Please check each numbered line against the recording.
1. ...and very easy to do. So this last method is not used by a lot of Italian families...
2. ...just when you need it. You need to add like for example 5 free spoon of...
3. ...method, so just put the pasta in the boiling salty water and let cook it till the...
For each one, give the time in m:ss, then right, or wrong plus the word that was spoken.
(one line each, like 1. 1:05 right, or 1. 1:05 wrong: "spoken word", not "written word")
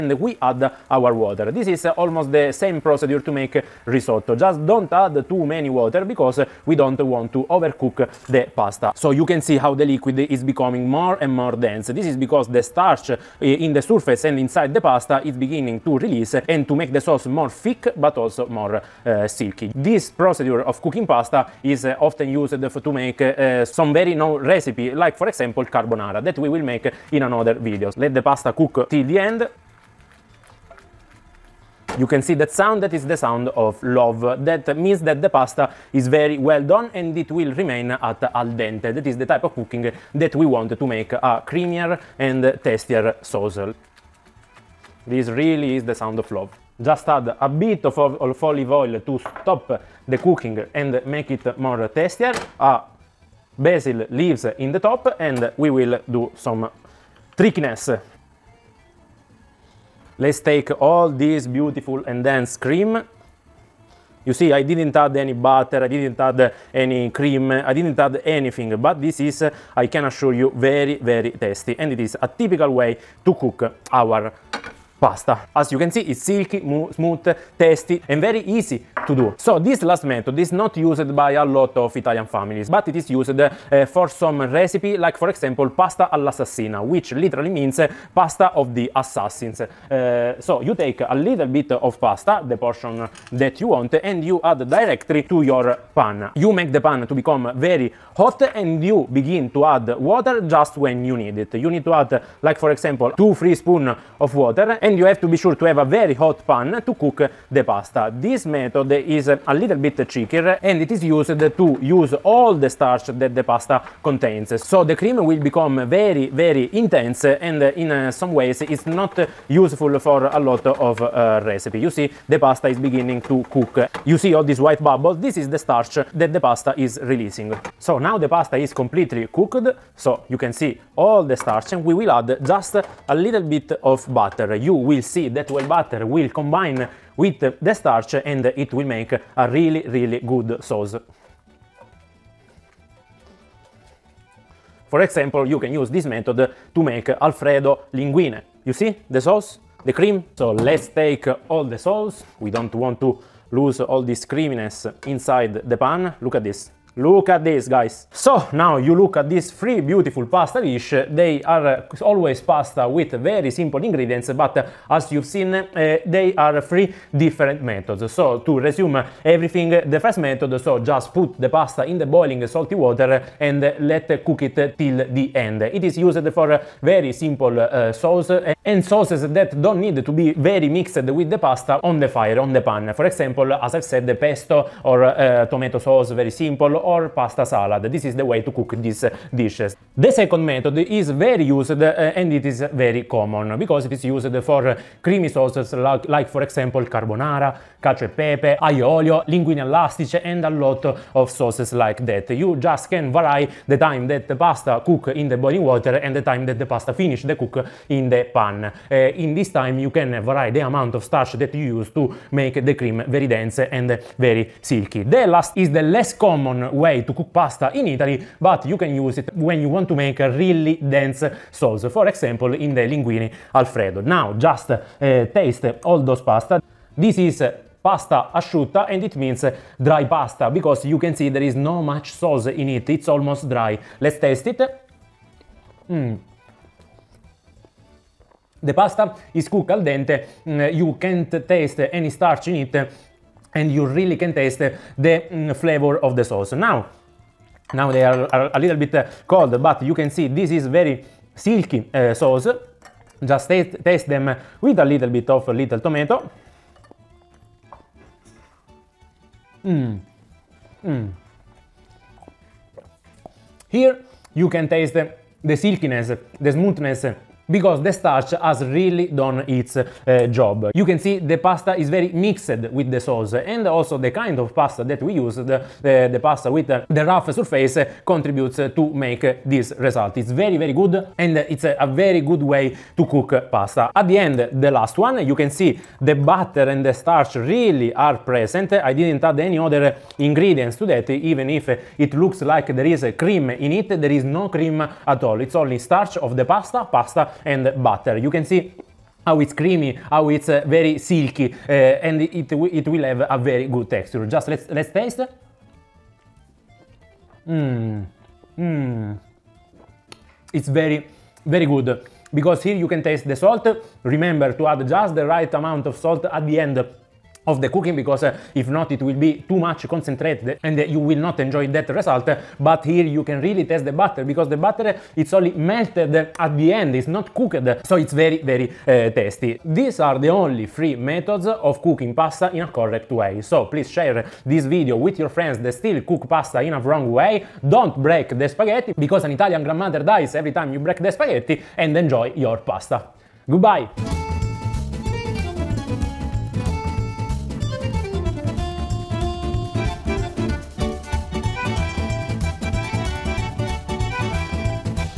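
1. 1:18 right
2. 1:40 wrong: "2", not "5"
3. 2:50 right.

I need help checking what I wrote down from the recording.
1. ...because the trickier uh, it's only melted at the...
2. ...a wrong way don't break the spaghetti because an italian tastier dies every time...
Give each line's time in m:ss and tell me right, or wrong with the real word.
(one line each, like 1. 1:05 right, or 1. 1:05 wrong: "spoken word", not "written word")
1. 5:24 wrong: "butter", not "trickier"
2. 5:36 wrong: "grandmother", not "tastier".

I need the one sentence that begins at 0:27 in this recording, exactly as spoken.
Let the pasta cook till the end You can see that sound, that is the sound of love.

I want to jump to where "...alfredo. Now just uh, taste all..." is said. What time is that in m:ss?
3:43.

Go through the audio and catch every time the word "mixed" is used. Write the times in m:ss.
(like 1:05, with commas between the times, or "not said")
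3:00, 4:32.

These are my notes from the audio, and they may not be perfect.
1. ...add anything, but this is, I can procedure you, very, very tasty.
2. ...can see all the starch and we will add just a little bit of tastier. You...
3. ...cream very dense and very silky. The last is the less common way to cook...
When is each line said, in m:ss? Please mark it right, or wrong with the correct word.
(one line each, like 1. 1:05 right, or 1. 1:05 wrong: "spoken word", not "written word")
1. 1:07 wrong: "assure", not "procedure"
2. 2:10 wrong: "butter", not "tastier"
3. 3:32 right.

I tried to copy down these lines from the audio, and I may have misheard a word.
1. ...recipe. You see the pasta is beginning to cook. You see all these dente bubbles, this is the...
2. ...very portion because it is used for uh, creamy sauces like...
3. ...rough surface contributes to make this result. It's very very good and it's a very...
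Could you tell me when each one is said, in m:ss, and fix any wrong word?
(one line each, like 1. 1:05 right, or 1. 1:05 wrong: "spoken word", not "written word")
1. 2:01 wrong: "white", not "dente"
2. 3:12 wrong: "common", not "portion"
3. 4:37 right.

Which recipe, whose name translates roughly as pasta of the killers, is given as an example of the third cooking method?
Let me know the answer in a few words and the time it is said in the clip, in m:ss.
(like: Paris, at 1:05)
pasta all'assassina, at 1:25.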